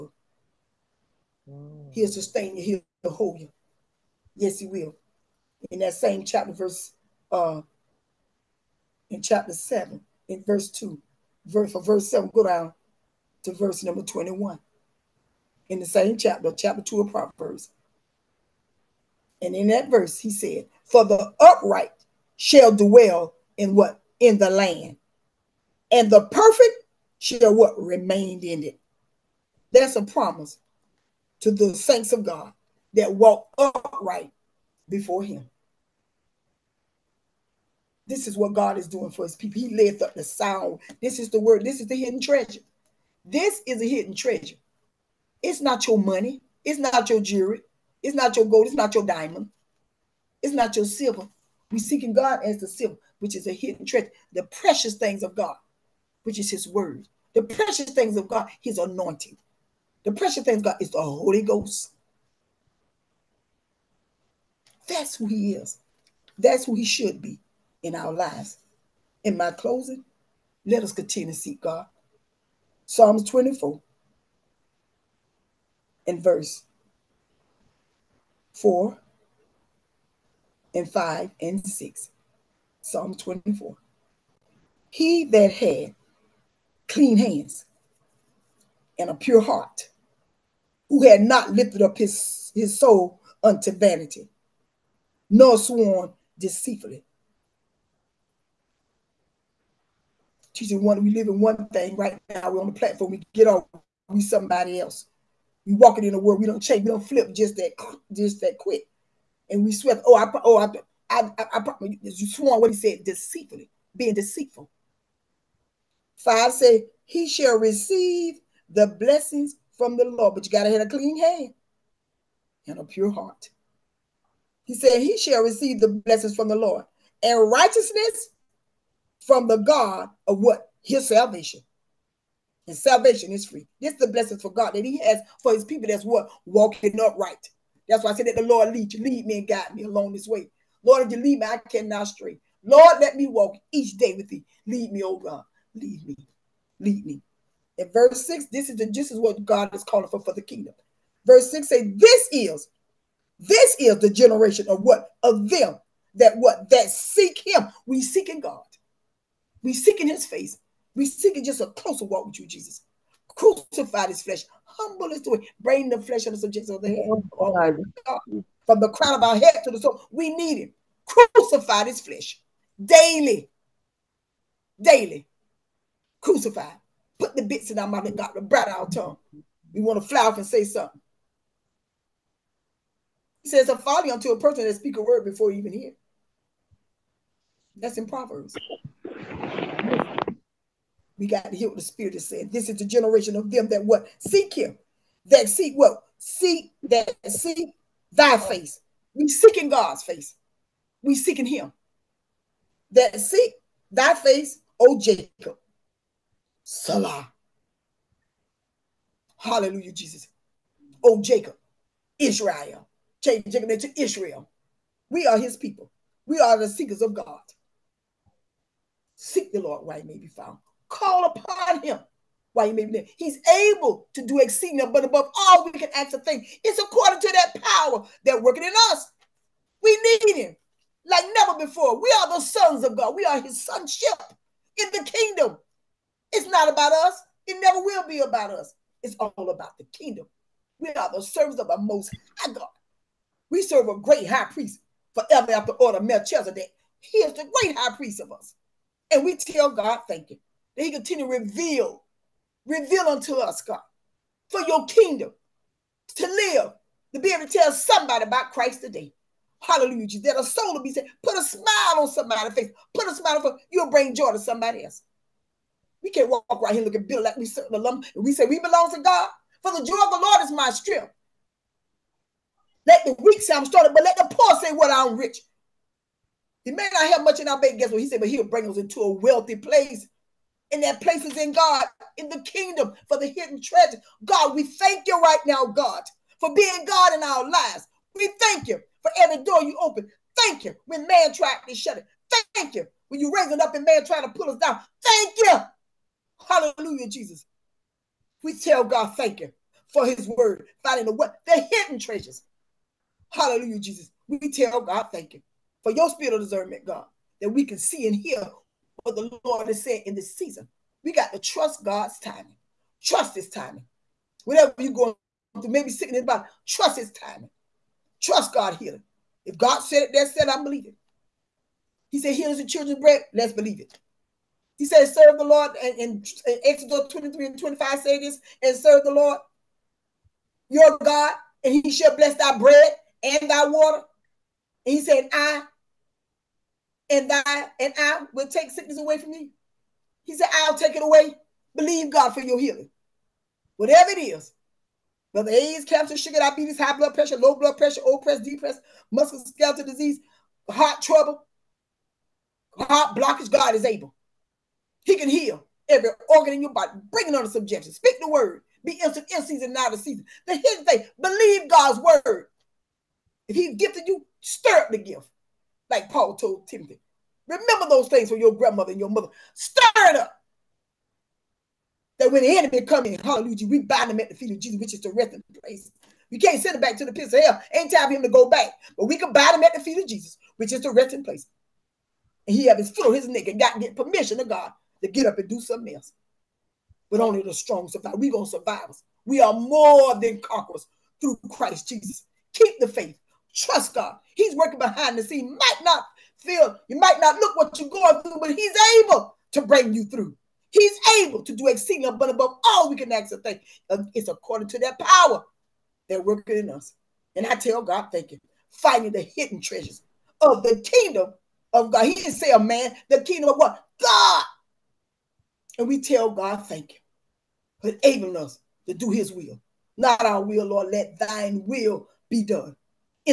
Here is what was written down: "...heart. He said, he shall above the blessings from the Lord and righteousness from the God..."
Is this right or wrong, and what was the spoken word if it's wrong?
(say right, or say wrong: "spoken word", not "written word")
wrong: "receive", not "above".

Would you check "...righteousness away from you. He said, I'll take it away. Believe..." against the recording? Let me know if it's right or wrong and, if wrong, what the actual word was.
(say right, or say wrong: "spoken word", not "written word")
wrong: "sickness", not "righteousness".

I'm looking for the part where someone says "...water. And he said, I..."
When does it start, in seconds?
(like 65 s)
333 s.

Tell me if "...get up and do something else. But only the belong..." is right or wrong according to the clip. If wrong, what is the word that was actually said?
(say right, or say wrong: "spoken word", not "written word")
wrong: "strong", not "belong".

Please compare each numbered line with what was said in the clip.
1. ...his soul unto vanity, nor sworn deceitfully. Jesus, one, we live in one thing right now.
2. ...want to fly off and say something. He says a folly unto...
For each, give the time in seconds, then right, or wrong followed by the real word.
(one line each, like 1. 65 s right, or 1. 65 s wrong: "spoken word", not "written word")
1. 92 s right
2. 179 s right.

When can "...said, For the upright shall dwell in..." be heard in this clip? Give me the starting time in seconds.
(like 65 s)
20 s.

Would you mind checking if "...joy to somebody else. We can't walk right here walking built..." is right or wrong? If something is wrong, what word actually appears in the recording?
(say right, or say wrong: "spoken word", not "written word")
wrong: "looking", not "walking".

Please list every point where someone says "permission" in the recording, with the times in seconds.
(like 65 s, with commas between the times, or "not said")
383 s.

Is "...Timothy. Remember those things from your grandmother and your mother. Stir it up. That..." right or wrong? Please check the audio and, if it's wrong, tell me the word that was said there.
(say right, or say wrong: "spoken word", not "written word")
right.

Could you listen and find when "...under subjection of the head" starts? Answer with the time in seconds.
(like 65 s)
166 s.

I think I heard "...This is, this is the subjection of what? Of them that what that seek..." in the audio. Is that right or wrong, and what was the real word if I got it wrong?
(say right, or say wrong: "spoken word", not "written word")
wrong: "generation", not "subjection".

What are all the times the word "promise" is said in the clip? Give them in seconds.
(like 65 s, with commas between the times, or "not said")
30 s.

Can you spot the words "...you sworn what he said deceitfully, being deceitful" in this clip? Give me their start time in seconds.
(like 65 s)
112 s.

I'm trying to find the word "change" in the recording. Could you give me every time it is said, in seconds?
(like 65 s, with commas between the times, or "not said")
106 s, 213 s.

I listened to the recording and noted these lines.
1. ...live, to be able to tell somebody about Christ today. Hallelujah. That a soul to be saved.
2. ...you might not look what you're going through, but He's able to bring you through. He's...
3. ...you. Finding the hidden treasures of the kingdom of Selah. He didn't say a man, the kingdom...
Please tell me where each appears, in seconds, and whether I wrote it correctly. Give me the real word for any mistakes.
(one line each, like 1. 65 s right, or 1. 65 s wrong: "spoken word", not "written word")
1. 256 s right
2. 396 s right
3. 408 s wrong: "God", not "Selah".